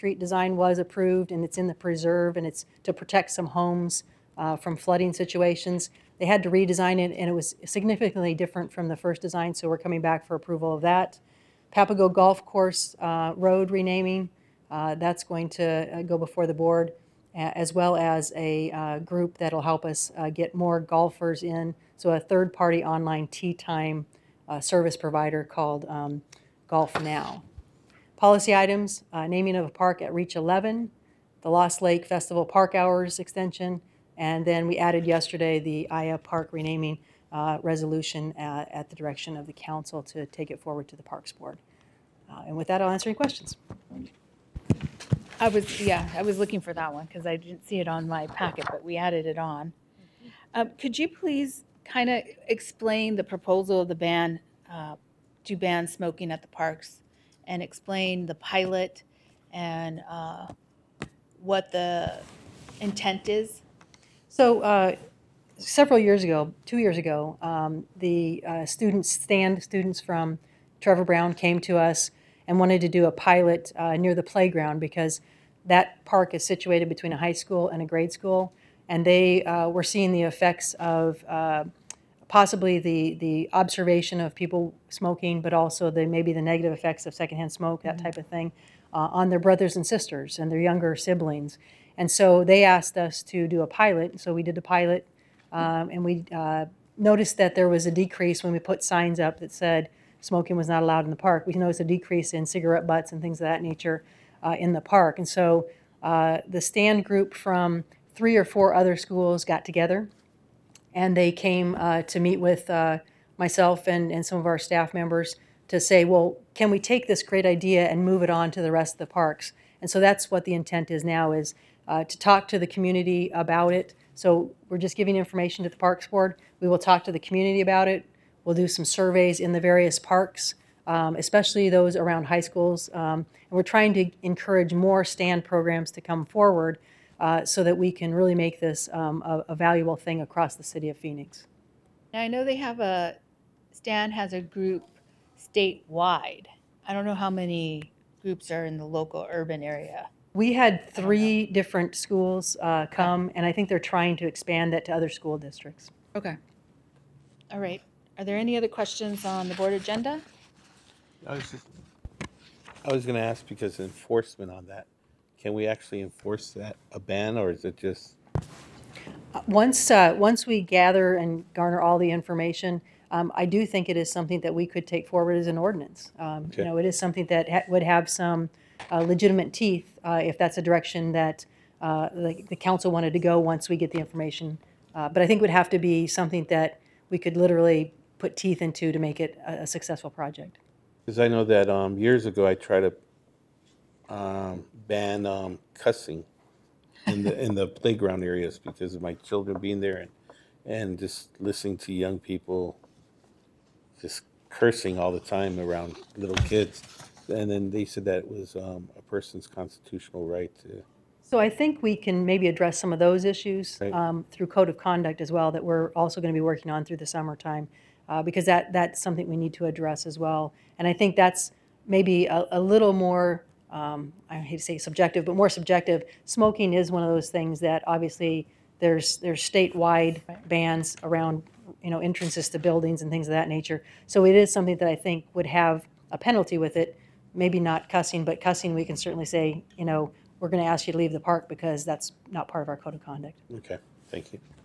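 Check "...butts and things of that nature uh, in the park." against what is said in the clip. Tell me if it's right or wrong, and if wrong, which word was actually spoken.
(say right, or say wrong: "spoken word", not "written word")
right.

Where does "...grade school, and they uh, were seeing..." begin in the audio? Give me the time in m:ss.
1:17.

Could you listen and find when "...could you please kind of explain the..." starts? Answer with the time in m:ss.
0:50.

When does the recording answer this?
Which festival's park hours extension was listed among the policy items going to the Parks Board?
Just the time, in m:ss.
0:31.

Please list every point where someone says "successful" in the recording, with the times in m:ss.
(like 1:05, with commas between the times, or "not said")
3:09.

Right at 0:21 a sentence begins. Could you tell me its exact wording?
So a third-party online tee time service provider called um, GolfNow.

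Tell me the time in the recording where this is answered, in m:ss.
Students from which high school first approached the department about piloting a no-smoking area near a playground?
1:10.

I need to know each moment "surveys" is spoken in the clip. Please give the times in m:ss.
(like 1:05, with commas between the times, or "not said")
2:08.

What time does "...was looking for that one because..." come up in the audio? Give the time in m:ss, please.
0:46.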